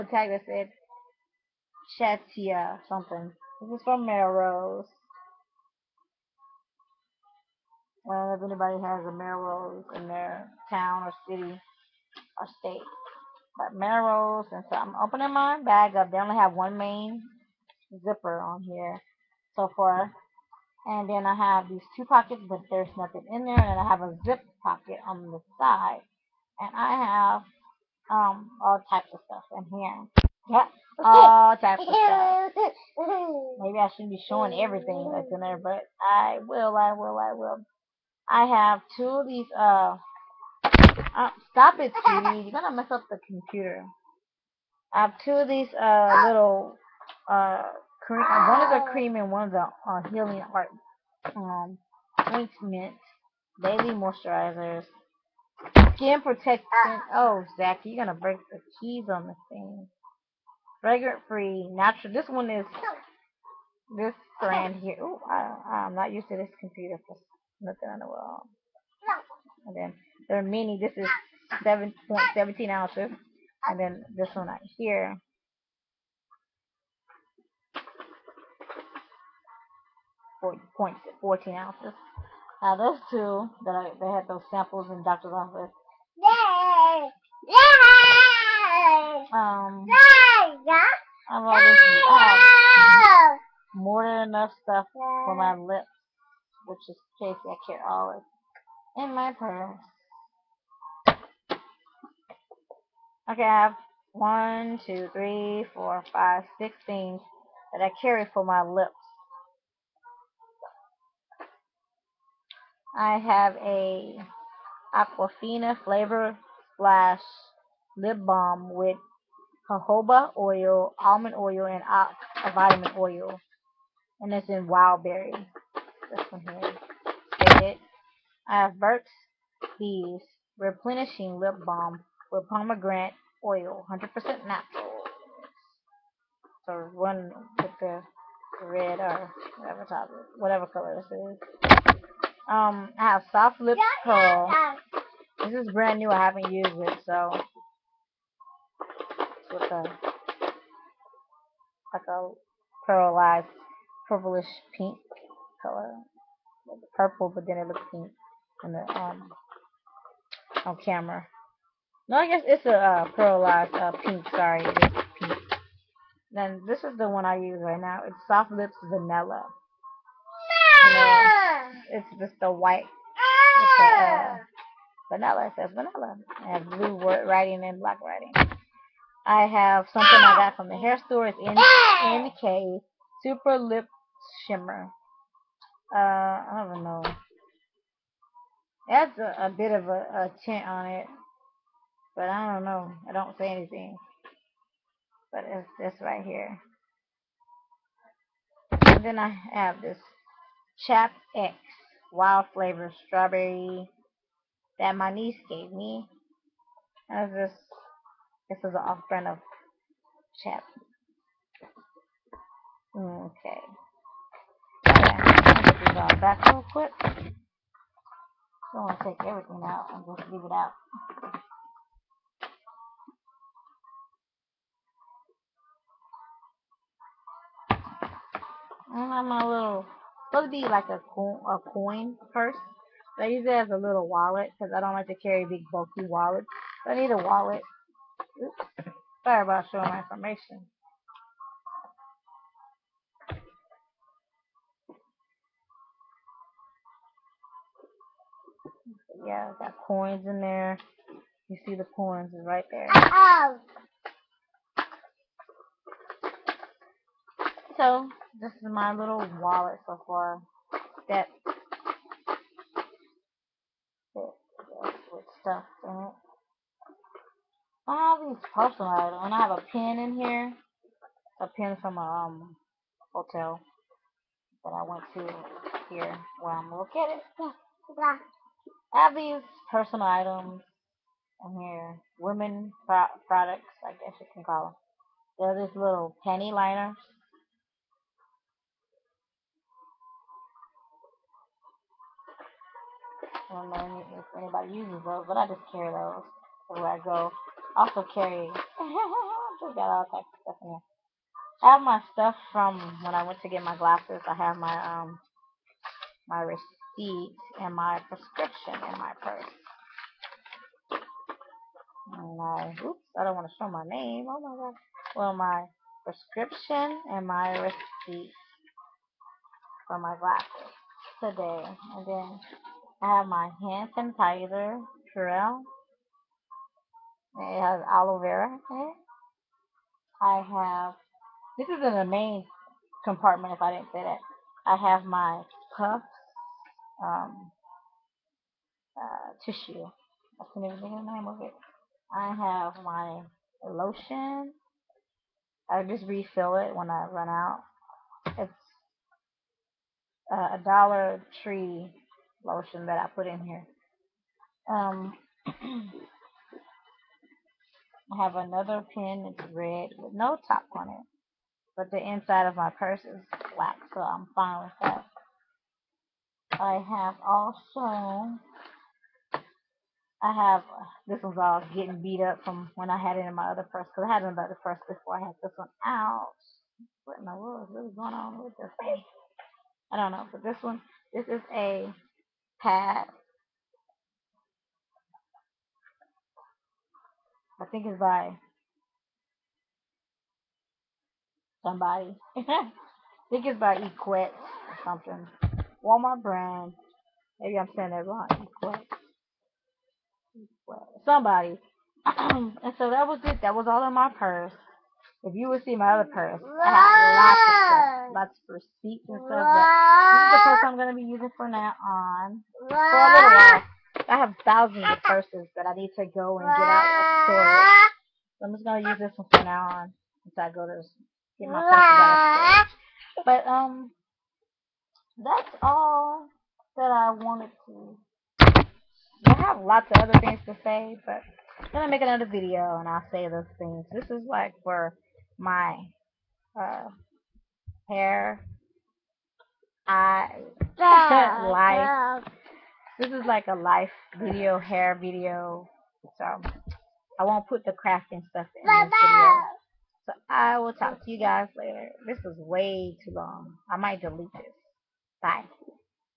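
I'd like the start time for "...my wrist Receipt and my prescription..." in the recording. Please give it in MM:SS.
05:06.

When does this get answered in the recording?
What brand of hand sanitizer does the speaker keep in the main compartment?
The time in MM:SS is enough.
05:25.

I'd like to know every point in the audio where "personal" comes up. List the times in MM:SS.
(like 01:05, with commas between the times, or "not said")
04:28, 04:39.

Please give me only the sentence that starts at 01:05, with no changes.
Ooh, I, I'm not used to this computer for not the world.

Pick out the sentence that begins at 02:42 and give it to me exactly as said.
No, I guess it's a uh, pearlized uh, pink.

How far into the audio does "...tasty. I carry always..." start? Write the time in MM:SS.
01:37.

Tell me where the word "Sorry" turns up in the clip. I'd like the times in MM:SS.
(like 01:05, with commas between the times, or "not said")
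02:44, 03:59.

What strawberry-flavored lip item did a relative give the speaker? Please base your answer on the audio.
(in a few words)
Chap X.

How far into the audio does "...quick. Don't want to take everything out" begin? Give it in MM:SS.
03:36.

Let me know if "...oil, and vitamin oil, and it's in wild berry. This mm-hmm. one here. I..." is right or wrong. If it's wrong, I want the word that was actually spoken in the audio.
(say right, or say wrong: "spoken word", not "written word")
right.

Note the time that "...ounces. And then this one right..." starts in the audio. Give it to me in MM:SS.
01:12.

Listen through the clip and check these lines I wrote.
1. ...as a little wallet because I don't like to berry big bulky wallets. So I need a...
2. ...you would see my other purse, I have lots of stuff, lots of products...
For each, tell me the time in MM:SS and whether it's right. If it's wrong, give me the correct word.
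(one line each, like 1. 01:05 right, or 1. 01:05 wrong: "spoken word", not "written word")
1. 03:53 wrong: "carry", not "berry"
2. 06:45 wrong: "receipts", not "products".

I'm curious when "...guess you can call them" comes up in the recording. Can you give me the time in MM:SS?
04:43.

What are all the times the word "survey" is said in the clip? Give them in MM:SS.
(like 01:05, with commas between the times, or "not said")
not said.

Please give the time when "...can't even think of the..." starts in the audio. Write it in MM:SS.
05:40.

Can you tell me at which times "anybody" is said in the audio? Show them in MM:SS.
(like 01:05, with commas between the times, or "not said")
00:08, 04:54.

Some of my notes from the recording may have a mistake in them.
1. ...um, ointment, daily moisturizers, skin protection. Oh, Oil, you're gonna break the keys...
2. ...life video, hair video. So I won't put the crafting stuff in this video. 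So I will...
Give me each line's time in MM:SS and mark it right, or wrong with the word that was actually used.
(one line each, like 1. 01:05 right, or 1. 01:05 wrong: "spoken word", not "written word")
1. 00:51 wrong: "Zach", not "Oil"
2. 07:23 right.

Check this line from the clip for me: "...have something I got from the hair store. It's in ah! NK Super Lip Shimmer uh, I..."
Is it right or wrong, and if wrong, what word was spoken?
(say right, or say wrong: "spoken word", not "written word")
right.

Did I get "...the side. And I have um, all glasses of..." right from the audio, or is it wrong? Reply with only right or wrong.
wrong.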